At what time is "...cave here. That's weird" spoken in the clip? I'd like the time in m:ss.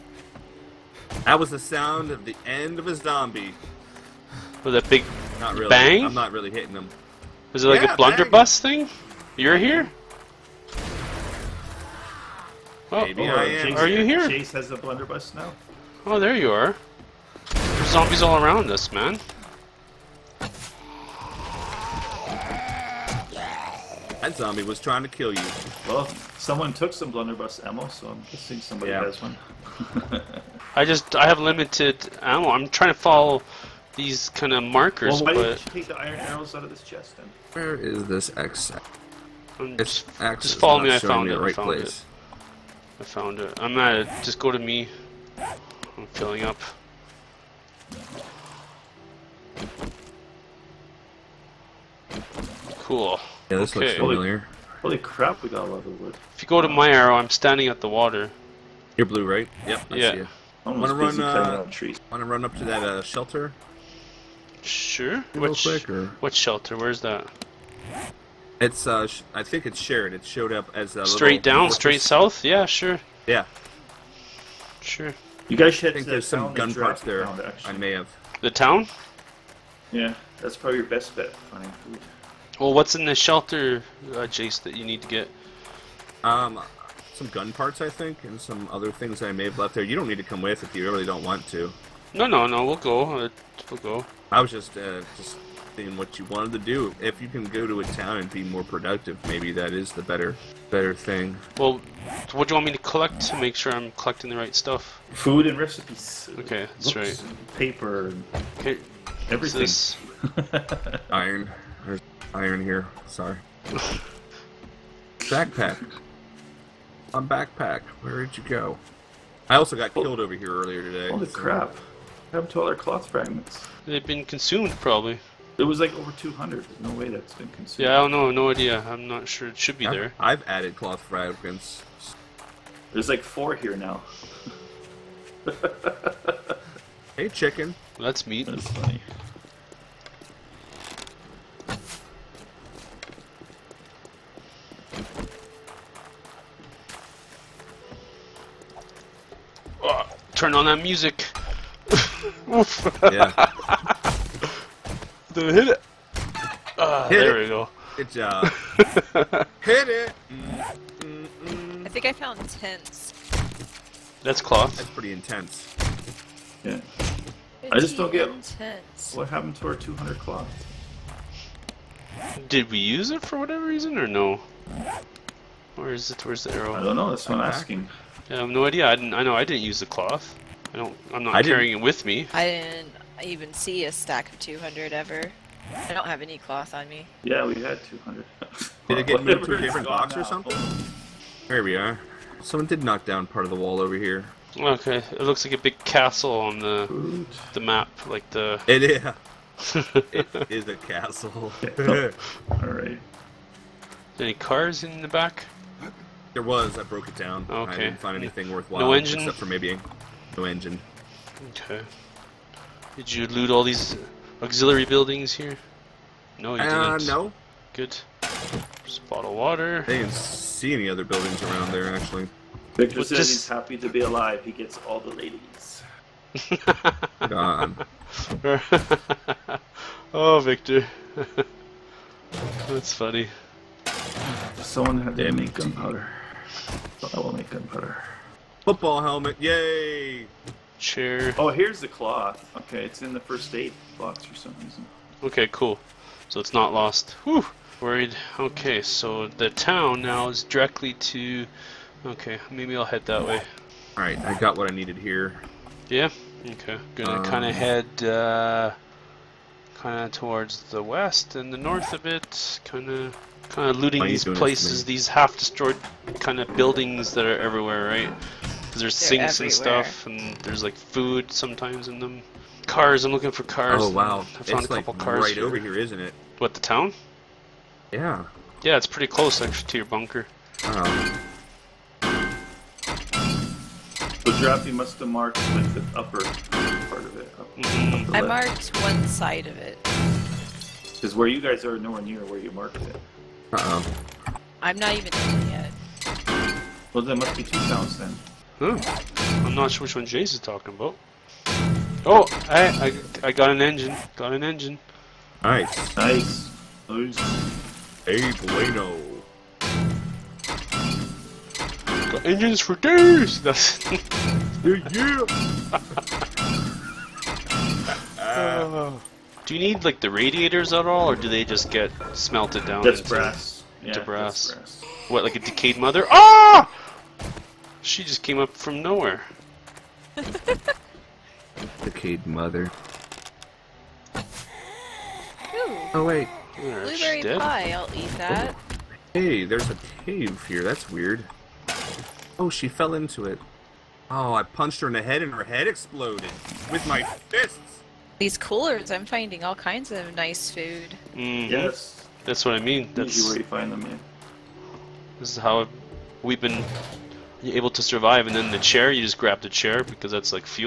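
5:40.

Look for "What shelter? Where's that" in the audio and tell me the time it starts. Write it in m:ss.
1:06.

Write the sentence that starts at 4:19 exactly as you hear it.
Kinda towards the west and the north of it.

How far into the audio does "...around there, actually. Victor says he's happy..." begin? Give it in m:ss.
3:41.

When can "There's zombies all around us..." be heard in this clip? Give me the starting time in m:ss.
0:17.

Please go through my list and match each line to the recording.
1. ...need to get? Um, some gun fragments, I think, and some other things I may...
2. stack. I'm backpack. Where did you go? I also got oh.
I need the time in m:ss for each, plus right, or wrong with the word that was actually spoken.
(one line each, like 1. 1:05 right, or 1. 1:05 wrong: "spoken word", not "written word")
1. 1:24 wrong: "parts", not "fragments"
2. 1:55 wrong: "backpack", not "stack".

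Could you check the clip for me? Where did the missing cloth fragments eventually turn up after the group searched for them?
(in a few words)
first aid box.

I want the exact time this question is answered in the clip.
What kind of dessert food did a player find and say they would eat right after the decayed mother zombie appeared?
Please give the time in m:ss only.
5:36.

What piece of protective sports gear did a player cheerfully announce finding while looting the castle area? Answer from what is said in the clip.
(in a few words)
Football helmet.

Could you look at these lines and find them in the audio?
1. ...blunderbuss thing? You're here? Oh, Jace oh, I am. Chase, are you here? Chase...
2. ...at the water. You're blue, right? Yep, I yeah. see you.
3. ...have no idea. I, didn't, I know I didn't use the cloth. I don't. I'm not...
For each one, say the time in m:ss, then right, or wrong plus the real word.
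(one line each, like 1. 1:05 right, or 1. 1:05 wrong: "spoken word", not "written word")
1. 0:07 wrong: "Maybe", not "Jace"
2. 0:57 right
3. 2:58 right.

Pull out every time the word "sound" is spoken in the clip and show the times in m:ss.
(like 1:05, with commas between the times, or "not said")
0:01, 4:57.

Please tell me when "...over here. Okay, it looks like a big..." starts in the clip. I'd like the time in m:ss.
3:13.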